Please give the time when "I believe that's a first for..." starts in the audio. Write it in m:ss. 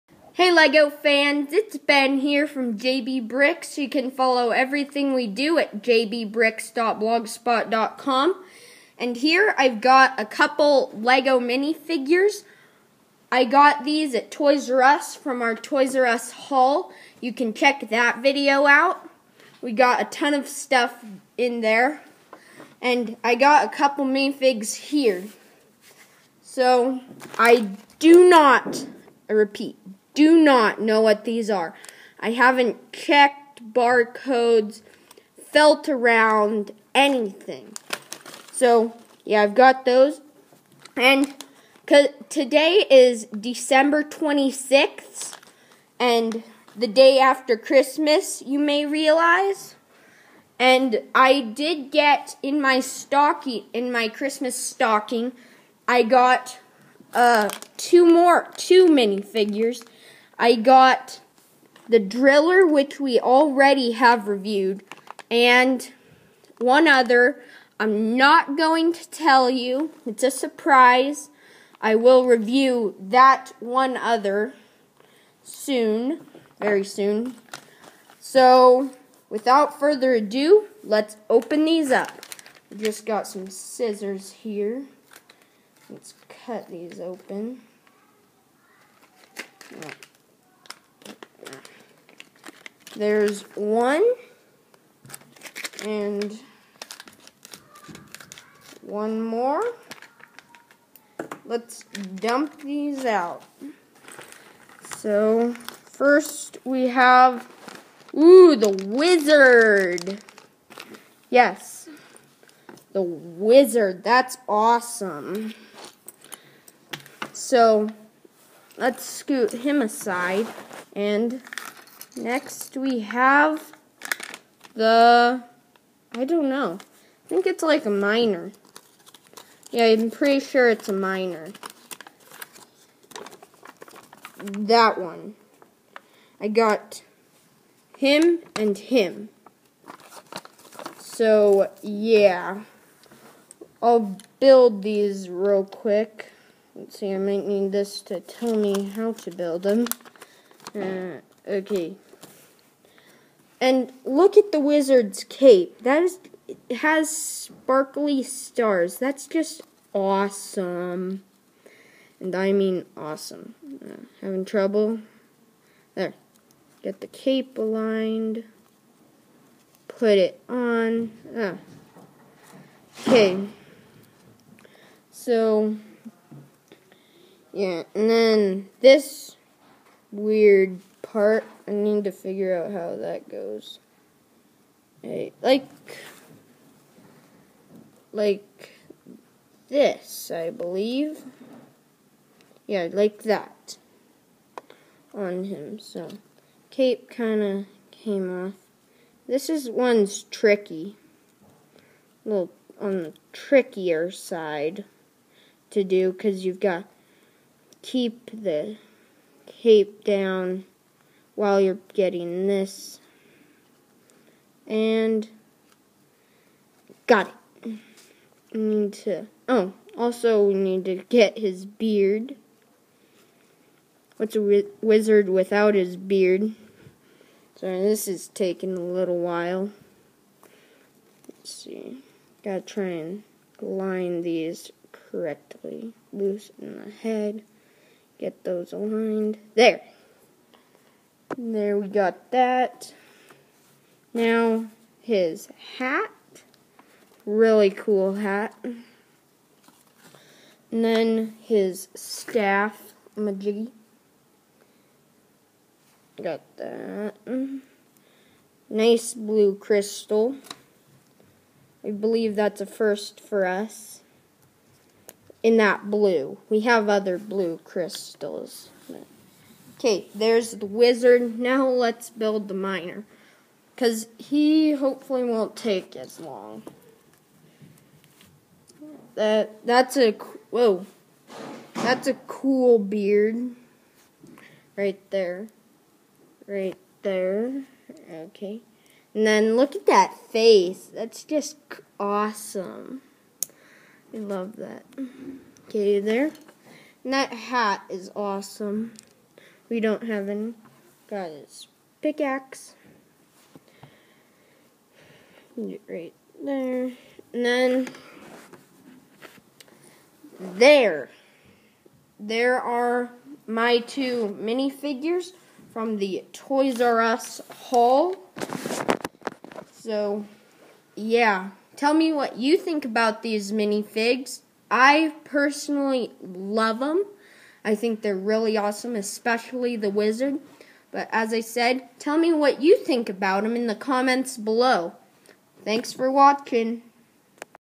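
4:21.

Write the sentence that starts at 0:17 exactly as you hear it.
You can check that video out.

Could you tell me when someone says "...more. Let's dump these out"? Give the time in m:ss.
1:39.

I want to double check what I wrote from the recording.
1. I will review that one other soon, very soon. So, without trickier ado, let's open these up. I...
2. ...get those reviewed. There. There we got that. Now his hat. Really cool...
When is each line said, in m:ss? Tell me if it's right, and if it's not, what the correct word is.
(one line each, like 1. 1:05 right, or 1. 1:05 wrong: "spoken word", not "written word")
1. 1:11 wrong: "further", not "trickier"
2. 3:58 wrong: "aligned", not "reviewed".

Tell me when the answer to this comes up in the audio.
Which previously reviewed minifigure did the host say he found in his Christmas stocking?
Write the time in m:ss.
1:01.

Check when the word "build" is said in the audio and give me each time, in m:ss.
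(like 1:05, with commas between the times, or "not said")
2:24, 2:29, 4:32.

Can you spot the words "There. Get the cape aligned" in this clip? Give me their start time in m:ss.
2:45.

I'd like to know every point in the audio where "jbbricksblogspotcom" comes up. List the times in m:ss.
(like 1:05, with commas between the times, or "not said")
0:05.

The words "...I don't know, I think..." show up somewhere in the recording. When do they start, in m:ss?
2:06.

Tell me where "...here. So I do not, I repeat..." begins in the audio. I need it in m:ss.
0:24.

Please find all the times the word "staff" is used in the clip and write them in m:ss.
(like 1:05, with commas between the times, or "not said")
4:11.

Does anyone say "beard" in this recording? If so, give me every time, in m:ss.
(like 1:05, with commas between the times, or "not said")
3:41, 3:45, 4:42.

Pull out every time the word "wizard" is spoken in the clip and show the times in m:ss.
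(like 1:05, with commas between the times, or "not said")
1:48, 1:53, 2:34, 3:44, 4:30, 5:29.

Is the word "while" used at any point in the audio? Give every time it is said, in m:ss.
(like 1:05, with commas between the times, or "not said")
3:31, 3:49.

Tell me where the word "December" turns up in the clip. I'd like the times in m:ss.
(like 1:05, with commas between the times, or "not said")
0:43.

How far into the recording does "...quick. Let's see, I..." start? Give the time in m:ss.
2:25.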